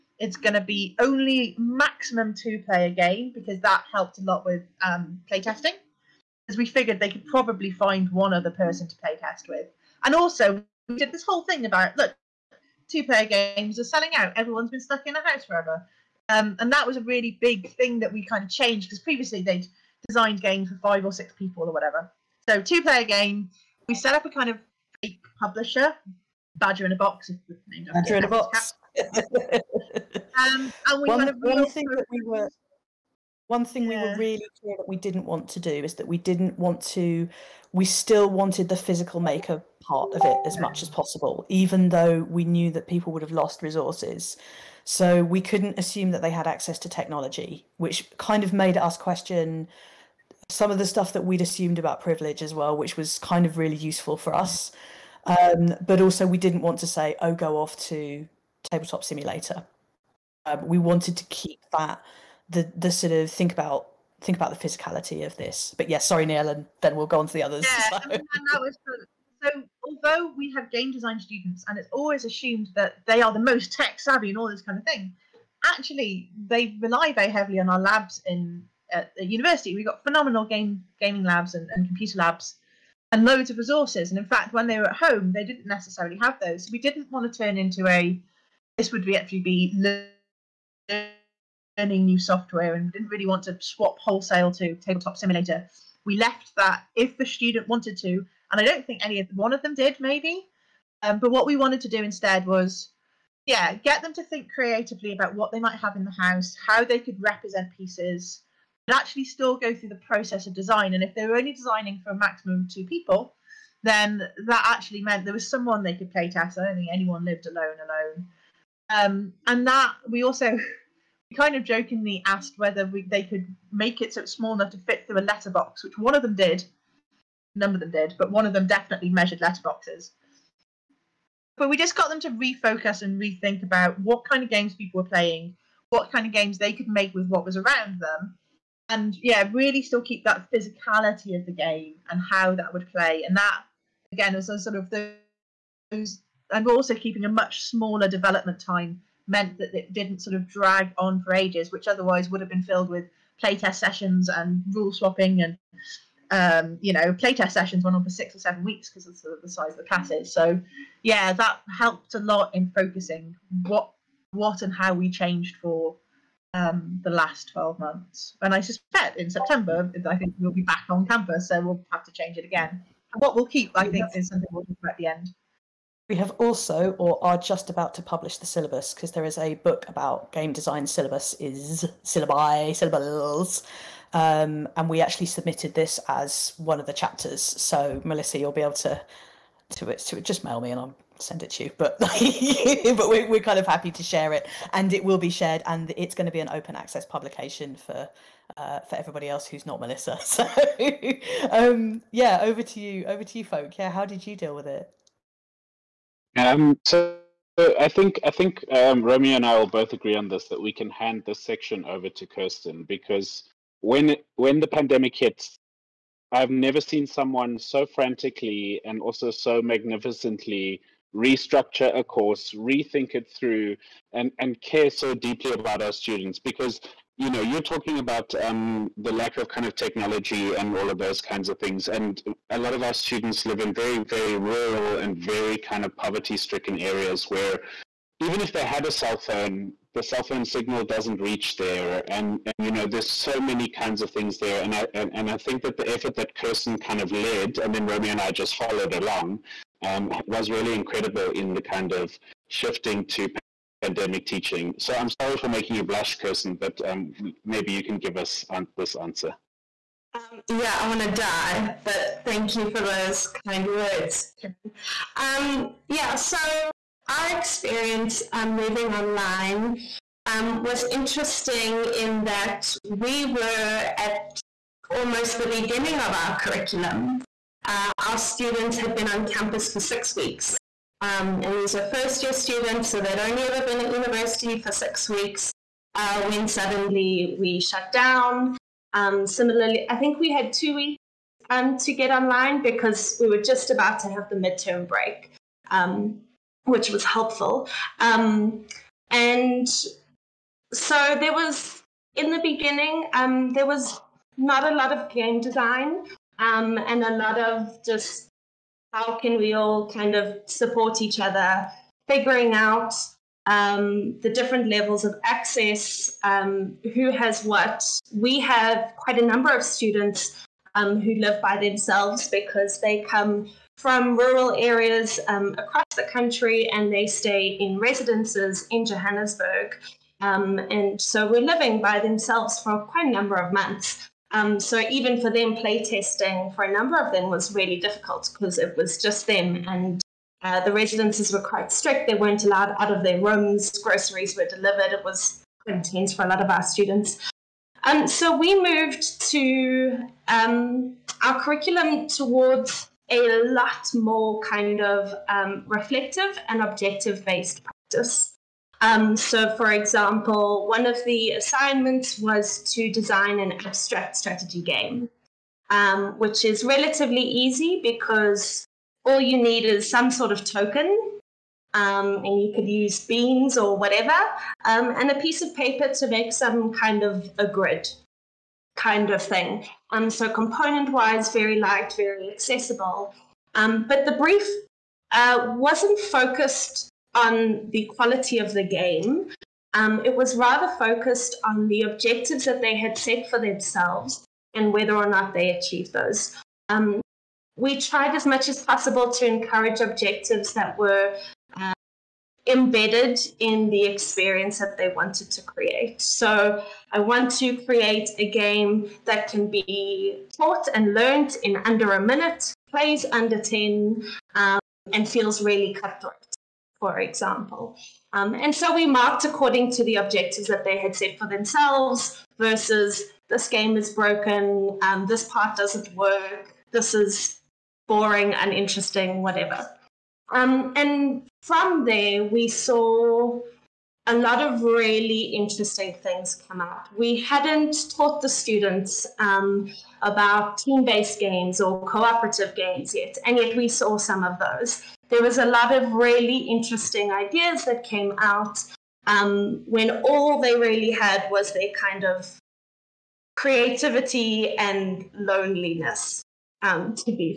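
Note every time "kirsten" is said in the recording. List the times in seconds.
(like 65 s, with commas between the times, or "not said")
212 s, 246 s, 256 s.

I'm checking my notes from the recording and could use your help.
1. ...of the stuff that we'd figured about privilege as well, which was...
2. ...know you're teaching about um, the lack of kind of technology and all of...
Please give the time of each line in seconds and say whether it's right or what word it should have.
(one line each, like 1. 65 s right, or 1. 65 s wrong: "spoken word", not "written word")
1. 50 s wrong: "assumed", not "figured"
2. 227 s wrong: "talking", not "teaching".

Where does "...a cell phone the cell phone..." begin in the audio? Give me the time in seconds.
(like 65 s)
238 s.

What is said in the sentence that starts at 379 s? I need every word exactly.
Um, so, component wise, very light, very accessible.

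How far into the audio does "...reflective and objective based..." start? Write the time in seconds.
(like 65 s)
355 s.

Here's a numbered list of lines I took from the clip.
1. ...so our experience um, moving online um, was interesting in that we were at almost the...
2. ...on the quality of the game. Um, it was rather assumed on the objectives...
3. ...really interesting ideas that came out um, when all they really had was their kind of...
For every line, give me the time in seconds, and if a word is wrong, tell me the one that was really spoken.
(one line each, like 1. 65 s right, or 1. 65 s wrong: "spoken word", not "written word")
1. 266 s right
2. 387 s wrong: "focused", not "assumed"
3. 445 s right.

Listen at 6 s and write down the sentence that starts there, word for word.
Because we figured they could probably find one other person to playtest with.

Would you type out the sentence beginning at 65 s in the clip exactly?
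But yes, yeah, sorry, Nia, and then we'll go on to the others.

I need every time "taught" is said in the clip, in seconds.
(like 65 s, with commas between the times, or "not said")
410 s, 437 s.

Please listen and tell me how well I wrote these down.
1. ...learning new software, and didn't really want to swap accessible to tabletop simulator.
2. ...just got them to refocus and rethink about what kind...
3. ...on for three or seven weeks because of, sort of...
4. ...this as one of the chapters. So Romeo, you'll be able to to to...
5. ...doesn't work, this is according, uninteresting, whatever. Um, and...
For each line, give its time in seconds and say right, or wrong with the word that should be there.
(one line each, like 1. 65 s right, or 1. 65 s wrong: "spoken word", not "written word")
1. 91 s wrong: "wholesale", not "accessible"
2. 131 s right
3. 157 s wrong: "six", not "three"
4. 185 s wrong: "Melissa", not "Romeo"
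5. 425 s wrong: "boring", not "according".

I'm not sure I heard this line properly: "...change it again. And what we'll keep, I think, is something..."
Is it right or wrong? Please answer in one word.
right.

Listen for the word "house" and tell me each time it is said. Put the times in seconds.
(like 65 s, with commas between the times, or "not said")
15 s, 106 s.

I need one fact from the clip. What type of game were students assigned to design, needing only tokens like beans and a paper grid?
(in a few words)
Abstract strategy game.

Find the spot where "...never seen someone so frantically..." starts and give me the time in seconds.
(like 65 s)
216 s.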